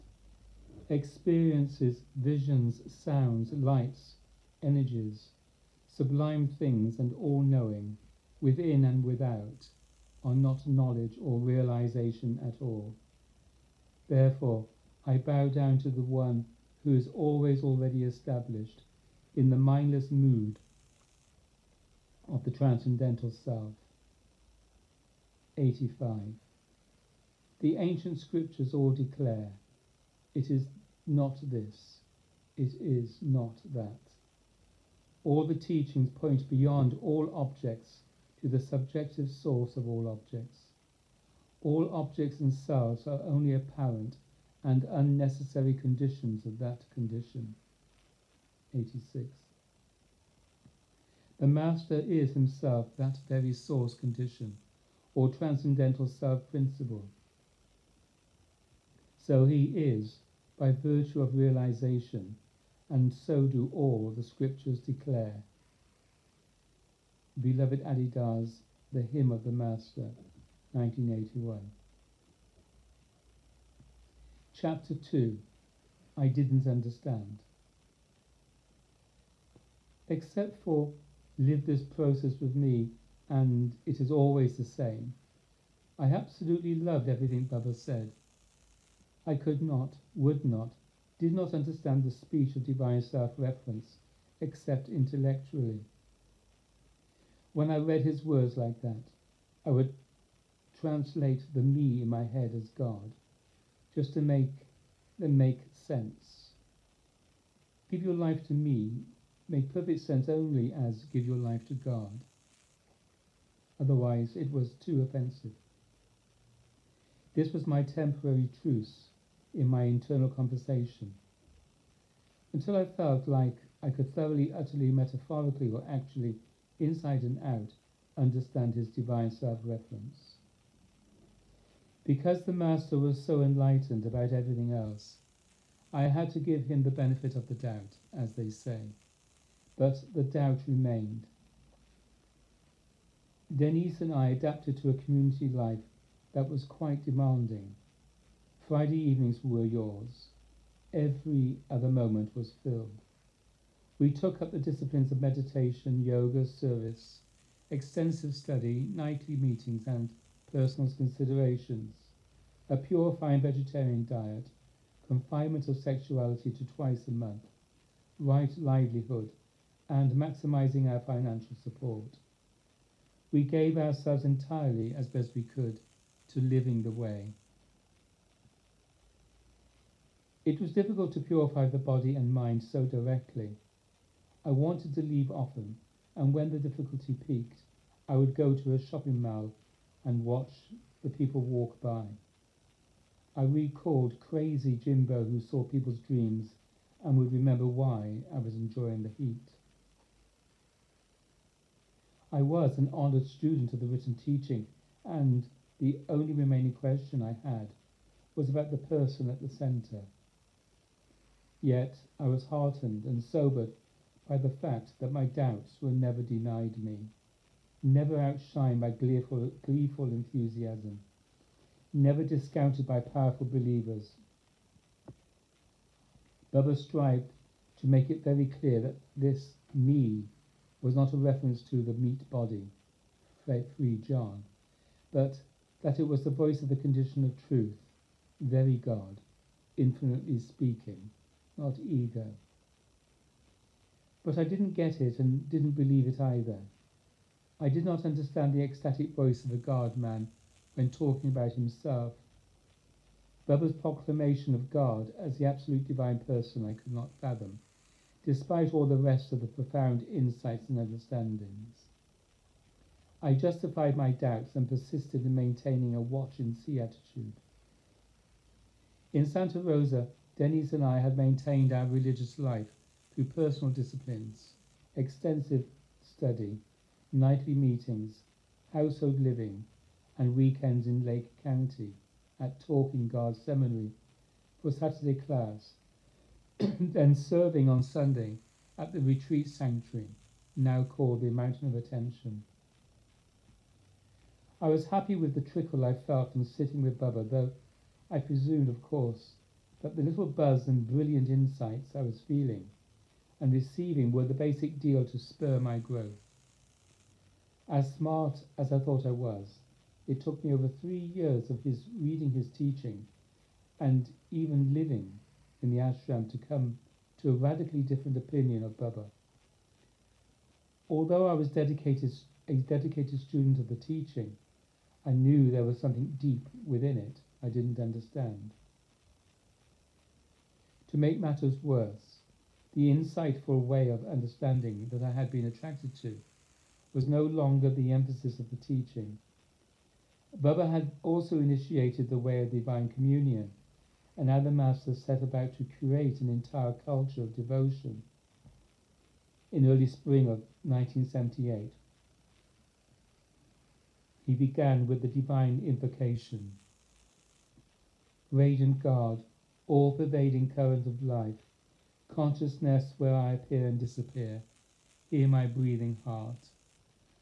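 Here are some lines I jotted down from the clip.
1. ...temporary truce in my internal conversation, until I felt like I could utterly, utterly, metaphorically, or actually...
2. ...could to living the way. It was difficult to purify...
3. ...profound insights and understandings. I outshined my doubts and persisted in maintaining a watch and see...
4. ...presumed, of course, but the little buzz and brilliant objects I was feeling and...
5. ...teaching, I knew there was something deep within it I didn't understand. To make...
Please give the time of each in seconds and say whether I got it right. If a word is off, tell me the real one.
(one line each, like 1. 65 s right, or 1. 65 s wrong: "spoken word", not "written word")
1. 117 s wrong: "thoroughly", not "utterly"
2. 175 s right
3. 259 s wrong: "justified", not "outshined"
4. 298 s wrong: "insights", not "objects"
5. 323 s right.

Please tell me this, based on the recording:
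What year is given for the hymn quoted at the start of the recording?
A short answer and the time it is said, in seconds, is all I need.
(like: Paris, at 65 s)
1981, at 70 s.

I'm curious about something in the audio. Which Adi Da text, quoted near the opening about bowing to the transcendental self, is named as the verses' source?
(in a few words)
The Hymn of the Master.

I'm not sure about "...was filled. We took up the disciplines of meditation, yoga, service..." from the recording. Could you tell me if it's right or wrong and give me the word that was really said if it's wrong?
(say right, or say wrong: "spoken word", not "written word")
right.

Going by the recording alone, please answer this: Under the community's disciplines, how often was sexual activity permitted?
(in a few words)
Twice a month.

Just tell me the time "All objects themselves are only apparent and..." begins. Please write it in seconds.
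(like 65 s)
41 s.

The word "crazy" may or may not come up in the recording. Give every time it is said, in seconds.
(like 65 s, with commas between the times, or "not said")
194 s.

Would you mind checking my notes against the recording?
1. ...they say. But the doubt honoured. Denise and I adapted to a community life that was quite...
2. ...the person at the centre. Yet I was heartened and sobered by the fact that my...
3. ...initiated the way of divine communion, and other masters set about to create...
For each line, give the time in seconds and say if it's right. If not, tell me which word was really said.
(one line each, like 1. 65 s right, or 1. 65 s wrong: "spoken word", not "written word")
1. 138 s wrong: "remained", not "honoured"
2. 208 s right
3. 341 s right.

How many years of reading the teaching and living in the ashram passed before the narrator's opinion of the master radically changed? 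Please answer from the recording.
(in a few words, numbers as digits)
3.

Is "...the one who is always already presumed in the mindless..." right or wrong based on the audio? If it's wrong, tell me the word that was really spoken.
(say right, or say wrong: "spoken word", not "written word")
wrong: "established", not "presumed".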